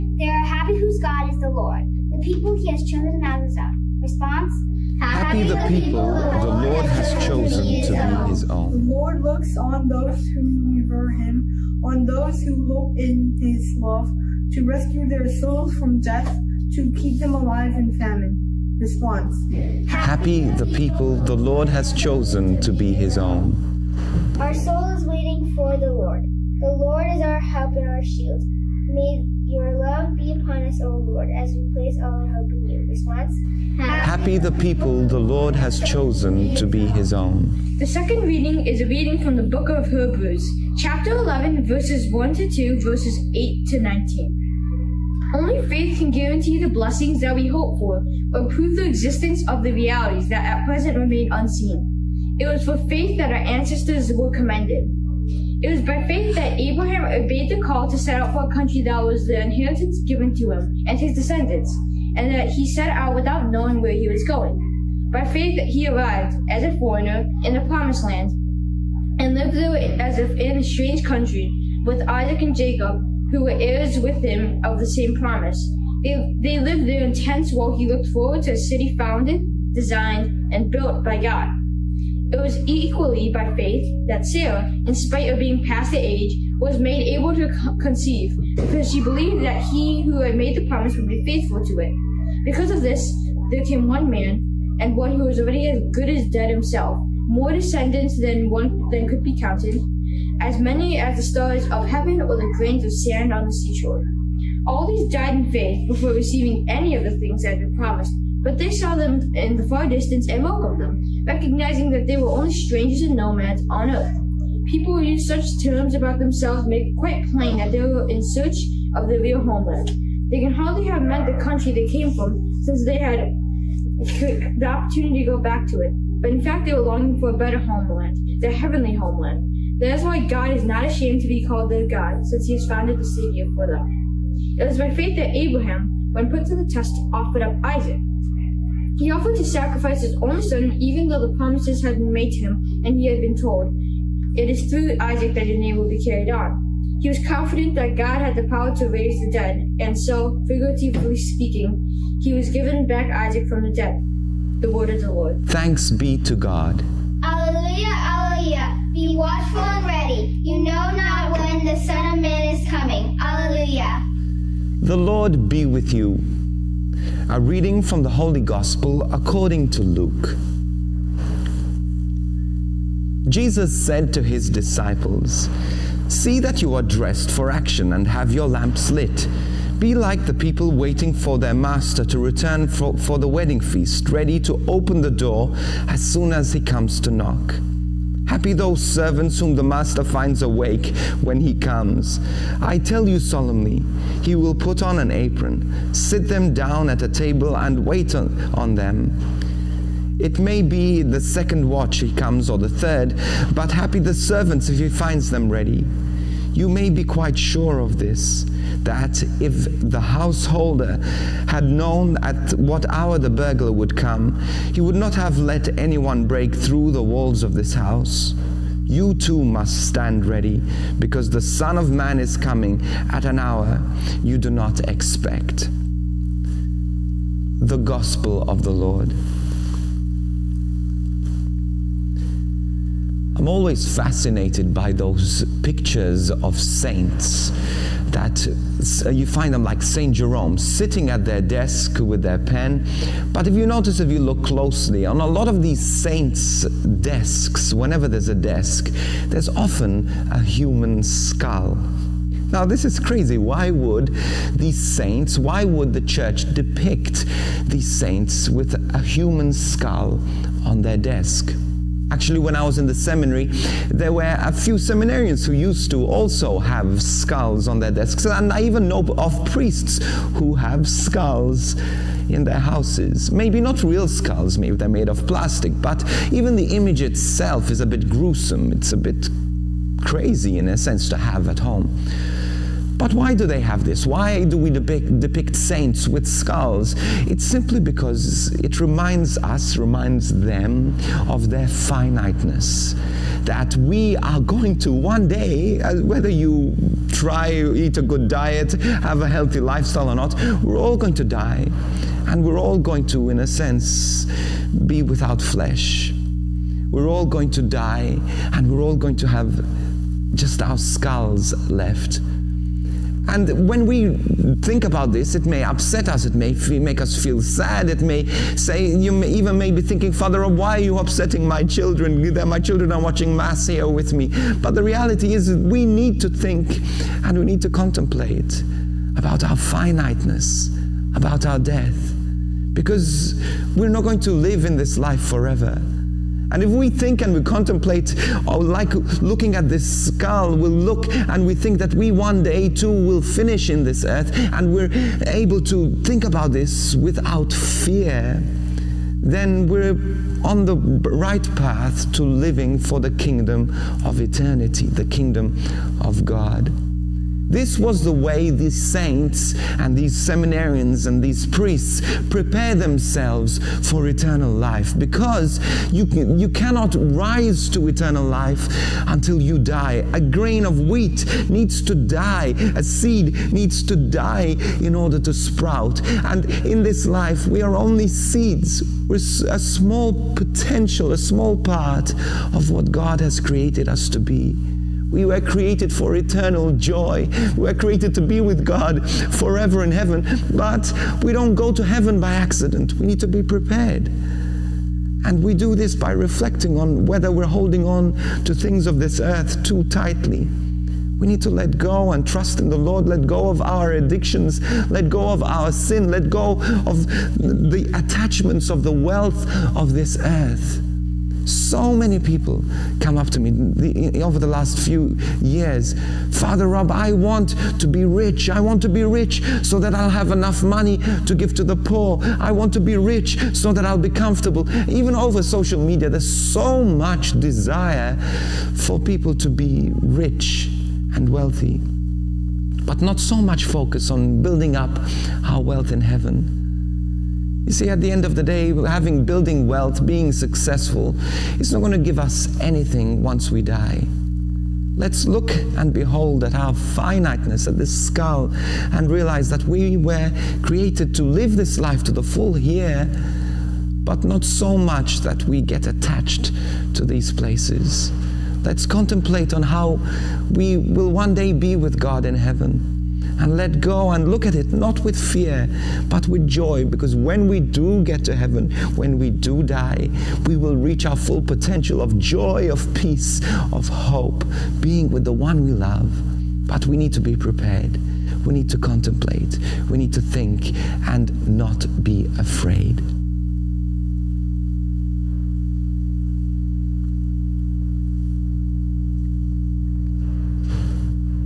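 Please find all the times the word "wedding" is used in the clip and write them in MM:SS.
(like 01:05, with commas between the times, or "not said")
03:03.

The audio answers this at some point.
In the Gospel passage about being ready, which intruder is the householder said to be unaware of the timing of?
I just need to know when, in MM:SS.
03:33.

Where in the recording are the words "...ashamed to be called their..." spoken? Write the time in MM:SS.
02:10.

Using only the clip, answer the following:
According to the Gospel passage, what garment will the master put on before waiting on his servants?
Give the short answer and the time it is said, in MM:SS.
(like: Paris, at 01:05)
An apron, at 03:14.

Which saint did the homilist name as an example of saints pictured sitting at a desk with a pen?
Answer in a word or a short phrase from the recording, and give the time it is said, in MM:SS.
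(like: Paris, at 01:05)
St. Jerome, at 03:59.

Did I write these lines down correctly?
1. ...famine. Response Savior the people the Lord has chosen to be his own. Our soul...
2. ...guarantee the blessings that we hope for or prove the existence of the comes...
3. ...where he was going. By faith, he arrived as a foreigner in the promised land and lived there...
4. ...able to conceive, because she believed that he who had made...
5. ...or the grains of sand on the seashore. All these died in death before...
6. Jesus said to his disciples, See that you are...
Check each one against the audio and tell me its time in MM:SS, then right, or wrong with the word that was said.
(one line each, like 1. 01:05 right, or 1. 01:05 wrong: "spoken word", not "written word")
1. 00:17 wrong: "Happy", not "Savior"
2. 00:46 wrong: "realities", not "comes"
3. 01:03 right
4. 01:27 right
5. 01:42 wrong: "faith", not "death"
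6. 02:53 right.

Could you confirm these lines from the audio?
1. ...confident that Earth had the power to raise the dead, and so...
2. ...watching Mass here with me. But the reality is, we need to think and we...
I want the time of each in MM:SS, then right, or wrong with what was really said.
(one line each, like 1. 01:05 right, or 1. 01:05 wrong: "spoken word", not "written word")
1. 02:27 wrong: "God", not "Earth"
2. 05:23 right.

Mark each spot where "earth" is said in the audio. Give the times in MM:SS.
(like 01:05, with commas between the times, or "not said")
01:53, 05:44, 06:39, 06:50.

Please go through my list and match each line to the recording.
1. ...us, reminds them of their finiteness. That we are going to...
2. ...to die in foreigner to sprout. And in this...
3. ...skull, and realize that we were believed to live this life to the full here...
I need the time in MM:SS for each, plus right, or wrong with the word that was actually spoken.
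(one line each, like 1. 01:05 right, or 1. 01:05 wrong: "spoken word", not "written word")
1. 04:49 right
2. 06:13 wrong: "order", not "foreigner"
3. 07:27 wrong: "created", not "believed".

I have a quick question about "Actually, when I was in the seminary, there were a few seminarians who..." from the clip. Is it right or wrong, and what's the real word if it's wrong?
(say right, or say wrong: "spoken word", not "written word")
right.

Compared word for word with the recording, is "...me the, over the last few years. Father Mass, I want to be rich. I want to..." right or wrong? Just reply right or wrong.
wrong.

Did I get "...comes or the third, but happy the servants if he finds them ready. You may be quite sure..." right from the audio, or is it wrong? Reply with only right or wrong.
right.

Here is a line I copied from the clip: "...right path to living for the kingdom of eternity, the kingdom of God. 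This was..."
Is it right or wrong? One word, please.
right.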